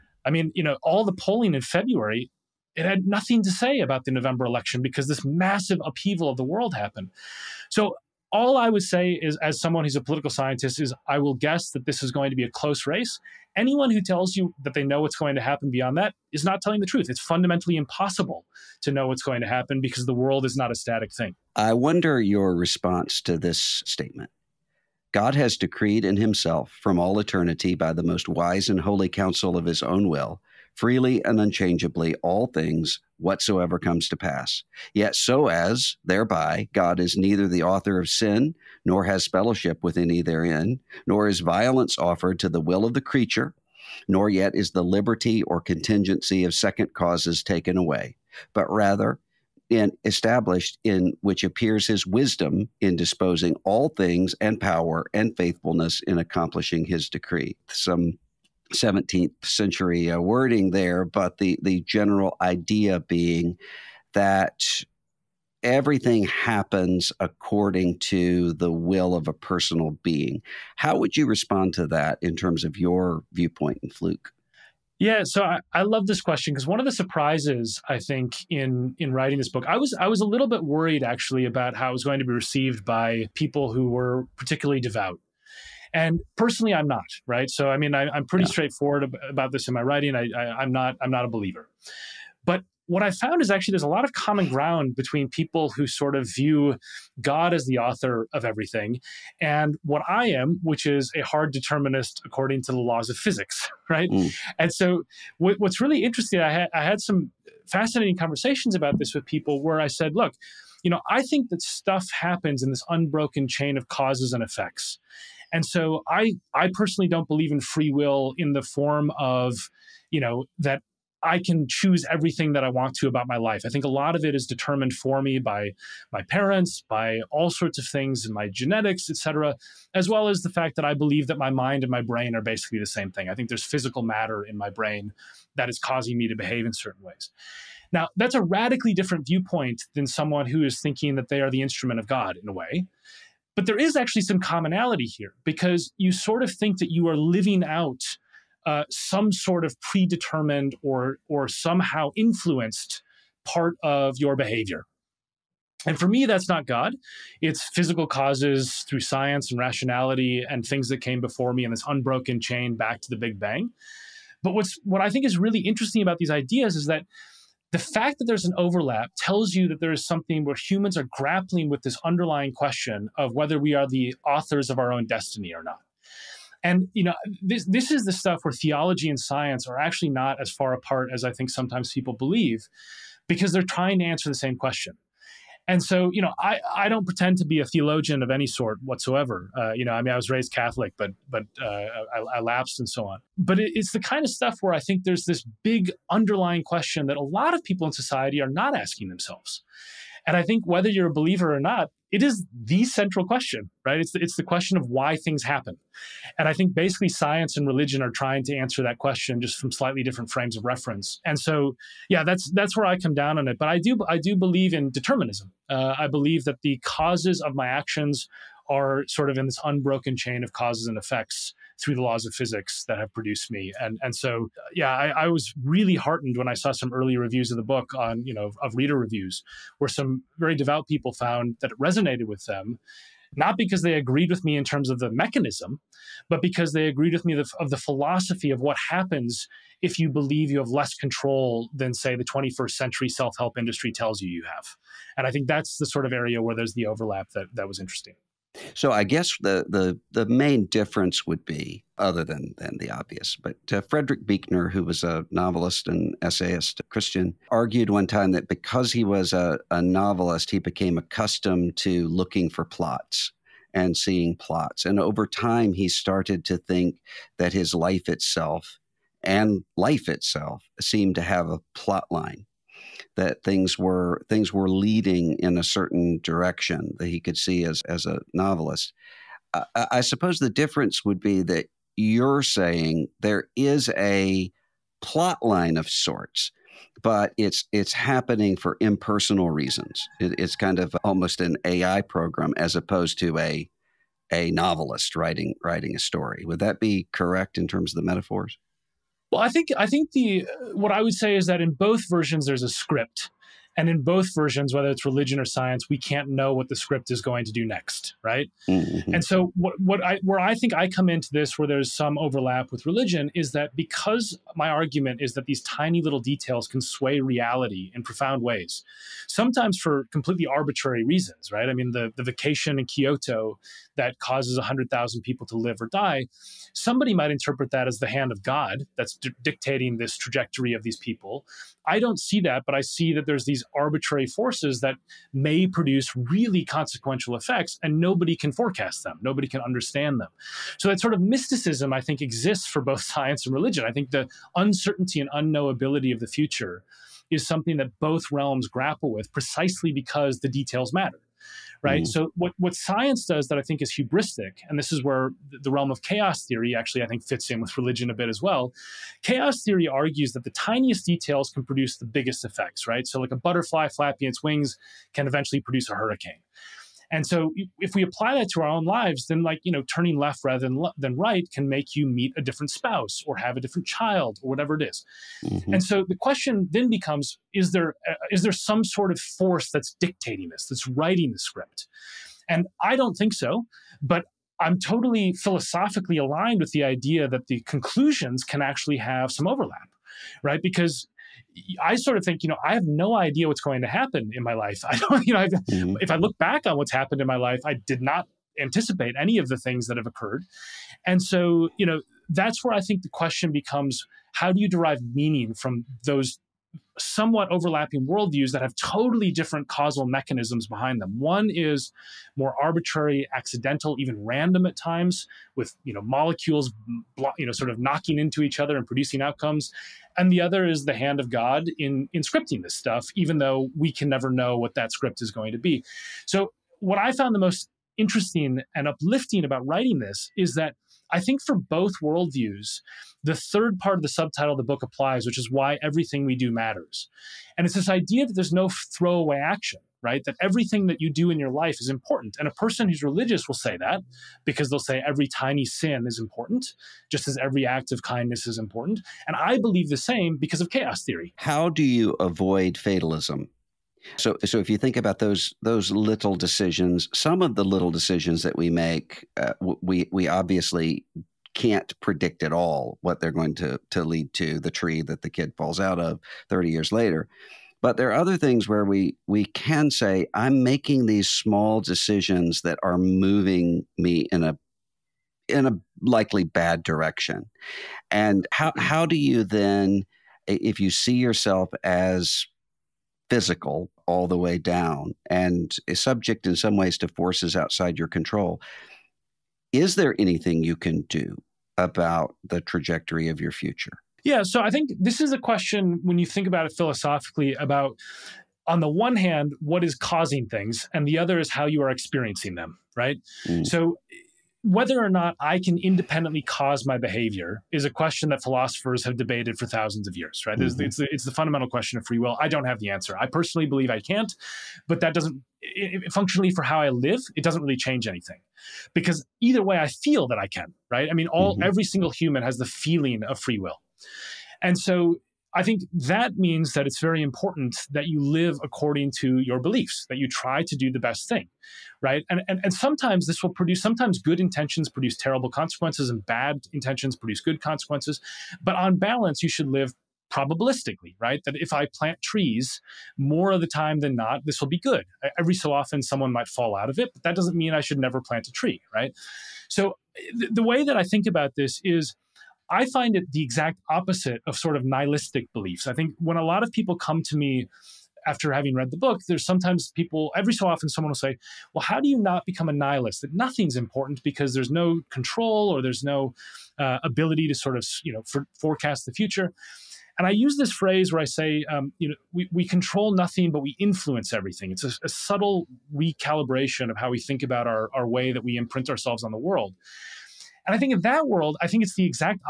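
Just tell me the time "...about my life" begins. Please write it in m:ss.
2:03.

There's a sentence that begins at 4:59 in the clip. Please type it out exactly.
Well, I think I think the what I would say is that in both versions there's a script.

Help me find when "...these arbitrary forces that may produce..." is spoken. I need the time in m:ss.
5:33.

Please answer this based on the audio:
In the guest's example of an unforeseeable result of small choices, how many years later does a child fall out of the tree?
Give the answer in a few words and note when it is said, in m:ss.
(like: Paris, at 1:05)
30, at 7:46.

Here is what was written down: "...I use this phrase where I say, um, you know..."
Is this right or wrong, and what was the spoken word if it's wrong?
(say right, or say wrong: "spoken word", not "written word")
right.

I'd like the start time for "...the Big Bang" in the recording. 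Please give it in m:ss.
2:43.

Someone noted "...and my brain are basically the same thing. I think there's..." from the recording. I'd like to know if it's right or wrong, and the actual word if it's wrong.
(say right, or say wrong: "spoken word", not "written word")
right.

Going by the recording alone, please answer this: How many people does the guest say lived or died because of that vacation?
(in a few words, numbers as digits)
100,000.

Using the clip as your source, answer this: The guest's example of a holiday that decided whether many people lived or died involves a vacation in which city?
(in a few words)
Kyoto.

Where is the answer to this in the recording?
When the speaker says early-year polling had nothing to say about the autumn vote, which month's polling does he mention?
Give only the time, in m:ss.
0:01.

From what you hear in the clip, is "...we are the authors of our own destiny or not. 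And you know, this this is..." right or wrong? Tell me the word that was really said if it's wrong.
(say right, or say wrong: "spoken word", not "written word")
right.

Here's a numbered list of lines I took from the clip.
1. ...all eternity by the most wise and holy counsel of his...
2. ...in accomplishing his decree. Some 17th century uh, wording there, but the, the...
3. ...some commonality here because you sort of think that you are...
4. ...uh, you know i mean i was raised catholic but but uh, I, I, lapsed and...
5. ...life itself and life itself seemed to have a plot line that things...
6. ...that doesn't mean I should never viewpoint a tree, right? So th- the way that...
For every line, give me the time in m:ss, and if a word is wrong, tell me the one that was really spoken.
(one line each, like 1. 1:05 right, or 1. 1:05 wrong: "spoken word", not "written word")
1. 0:26 right
2. 0:56 right
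3. 2:24 right
4. 3:09 right
5. 4:27 right
6. 9:07 wrong: "plant", not "viewpoint".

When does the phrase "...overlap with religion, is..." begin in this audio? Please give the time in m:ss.
5:12.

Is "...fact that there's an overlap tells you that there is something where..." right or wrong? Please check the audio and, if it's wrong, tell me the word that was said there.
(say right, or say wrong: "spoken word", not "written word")
right.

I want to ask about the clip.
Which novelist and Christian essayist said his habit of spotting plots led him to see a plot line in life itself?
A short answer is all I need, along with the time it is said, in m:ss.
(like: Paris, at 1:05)
Frederick Buechner, at 4:13.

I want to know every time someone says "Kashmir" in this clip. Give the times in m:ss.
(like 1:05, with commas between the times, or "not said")
not said.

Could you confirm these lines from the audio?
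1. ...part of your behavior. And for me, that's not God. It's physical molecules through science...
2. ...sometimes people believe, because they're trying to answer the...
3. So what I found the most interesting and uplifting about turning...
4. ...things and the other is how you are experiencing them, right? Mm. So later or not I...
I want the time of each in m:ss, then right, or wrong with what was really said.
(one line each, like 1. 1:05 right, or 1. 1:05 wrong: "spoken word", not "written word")
1. 2:33 wrong: "causes", not "molecules"
2. 3:01 right
3. 7:06 wrong: "writing", not "turning"
4. 8:20 wrong: "whether", not "later".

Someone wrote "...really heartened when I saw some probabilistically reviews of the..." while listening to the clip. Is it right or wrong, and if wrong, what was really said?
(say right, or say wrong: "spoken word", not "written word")
wrong: "early", not "probabilistically".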